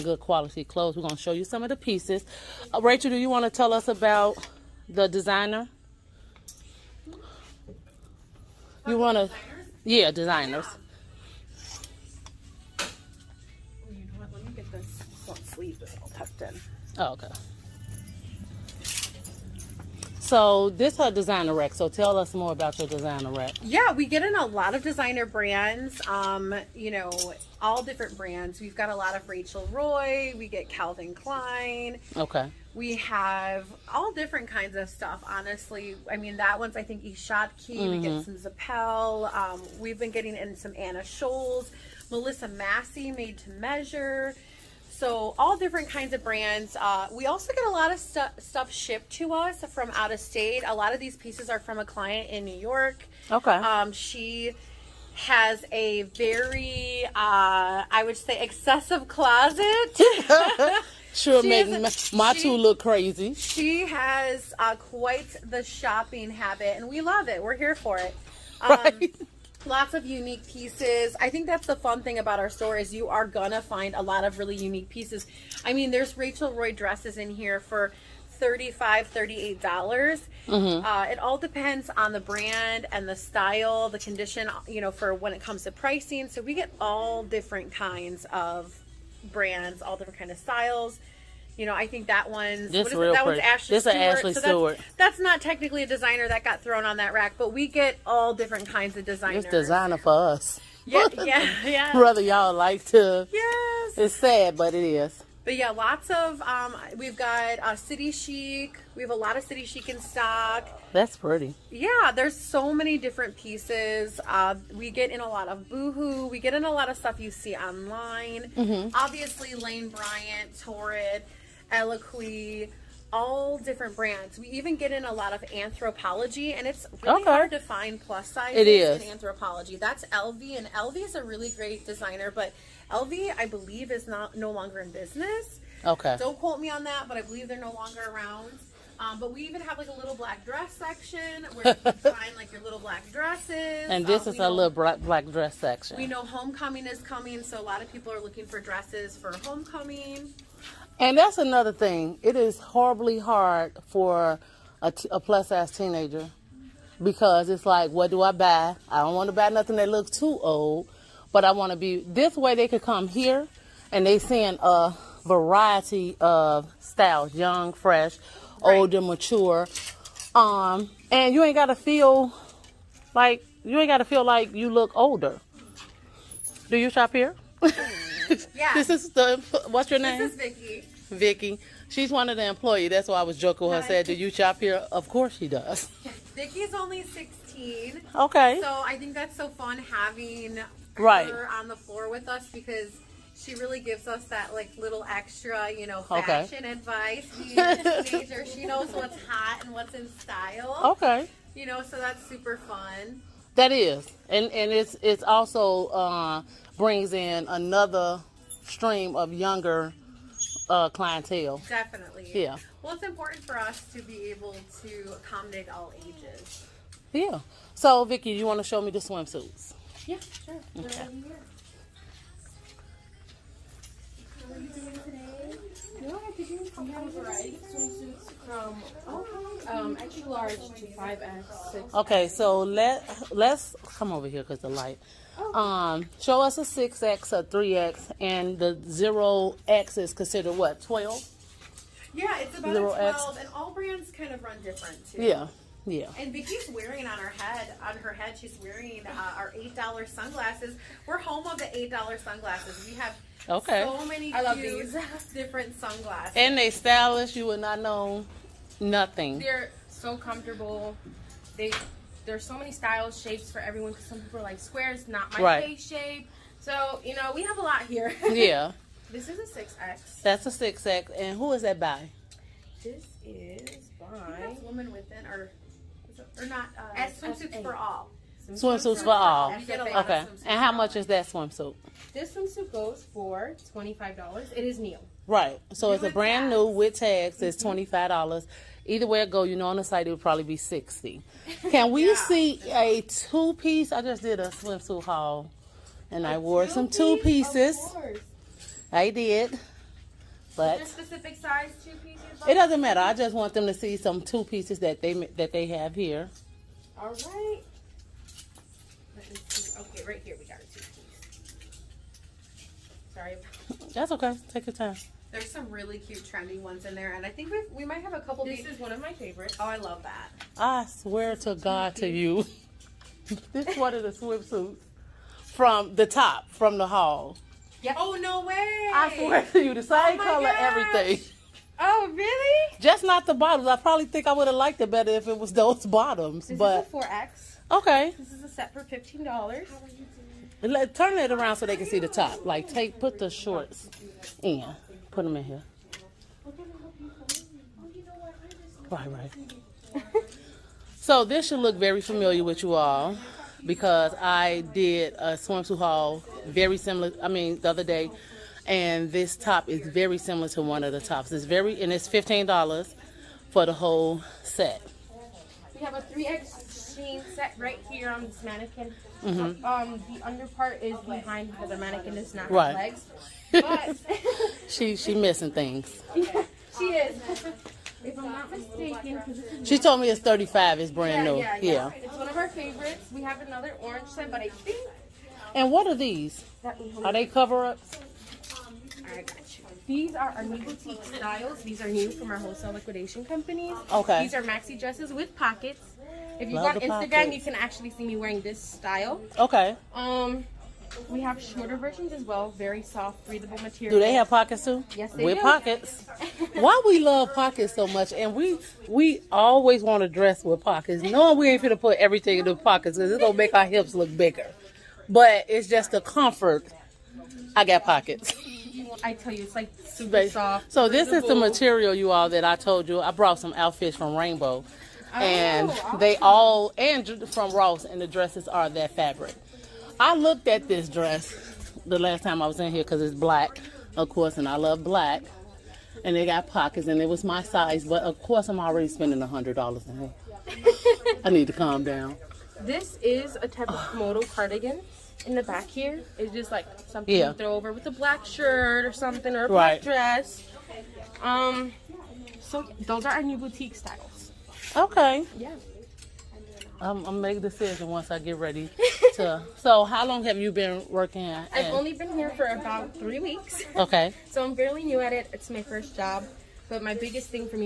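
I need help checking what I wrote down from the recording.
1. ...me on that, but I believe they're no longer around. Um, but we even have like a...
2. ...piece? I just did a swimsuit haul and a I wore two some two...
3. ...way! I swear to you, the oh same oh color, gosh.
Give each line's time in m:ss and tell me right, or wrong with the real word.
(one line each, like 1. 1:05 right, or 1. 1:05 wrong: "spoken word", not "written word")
1. 2:16 right
2. 4:53 right
3. 5:28 right.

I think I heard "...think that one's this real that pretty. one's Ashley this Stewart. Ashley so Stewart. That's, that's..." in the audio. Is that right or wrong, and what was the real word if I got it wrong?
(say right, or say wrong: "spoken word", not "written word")
right.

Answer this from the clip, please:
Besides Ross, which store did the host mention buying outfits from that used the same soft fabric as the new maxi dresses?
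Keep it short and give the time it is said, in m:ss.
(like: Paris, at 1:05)
Rainbow, at 7:04.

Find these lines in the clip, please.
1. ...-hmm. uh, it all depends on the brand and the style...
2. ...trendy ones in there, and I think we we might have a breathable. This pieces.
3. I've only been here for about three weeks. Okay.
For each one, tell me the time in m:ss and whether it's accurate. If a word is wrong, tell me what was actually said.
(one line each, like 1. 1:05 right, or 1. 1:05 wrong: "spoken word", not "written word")
1. 1:20 right
2. 5:16 wrong: "couple", not "breathable"
3. 7:41 right.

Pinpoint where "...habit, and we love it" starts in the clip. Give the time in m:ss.
1:06.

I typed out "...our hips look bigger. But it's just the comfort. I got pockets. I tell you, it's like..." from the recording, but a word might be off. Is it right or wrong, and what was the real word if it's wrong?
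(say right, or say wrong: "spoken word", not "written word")
right.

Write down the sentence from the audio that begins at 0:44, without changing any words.
So all different kinds of brands.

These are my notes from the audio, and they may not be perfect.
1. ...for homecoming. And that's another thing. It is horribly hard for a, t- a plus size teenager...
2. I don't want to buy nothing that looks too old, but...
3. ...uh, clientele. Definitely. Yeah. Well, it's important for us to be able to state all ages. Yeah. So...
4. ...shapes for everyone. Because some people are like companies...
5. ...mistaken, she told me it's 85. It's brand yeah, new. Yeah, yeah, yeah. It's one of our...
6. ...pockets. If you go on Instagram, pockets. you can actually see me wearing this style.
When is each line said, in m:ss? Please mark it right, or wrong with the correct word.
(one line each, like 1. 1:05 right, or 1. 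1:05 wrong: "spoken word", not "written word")
1. 2:29 right
2. 2:38 right
3. 3:30 wrong: "accommodate", not "state"
4. 4:23 wrong: "squares", not "companies"
5. 6:18 wrong: "35", not "85"
6. 6:35 right.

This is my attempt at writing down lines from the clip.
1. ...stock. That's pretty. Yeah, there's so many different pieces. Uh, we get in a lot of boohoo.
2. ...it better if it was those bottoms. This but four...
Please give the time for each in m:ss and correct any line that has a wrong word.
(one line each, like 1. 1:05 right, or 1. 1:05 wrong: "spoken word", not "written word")
1. 1:49 right
2. 5:34 right.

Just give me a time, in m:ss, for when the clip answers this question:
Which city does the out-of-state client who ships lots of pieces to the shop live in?
0:52.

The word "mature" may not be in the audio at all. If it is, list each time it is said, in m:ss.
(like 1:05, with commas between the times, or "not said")
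2:48.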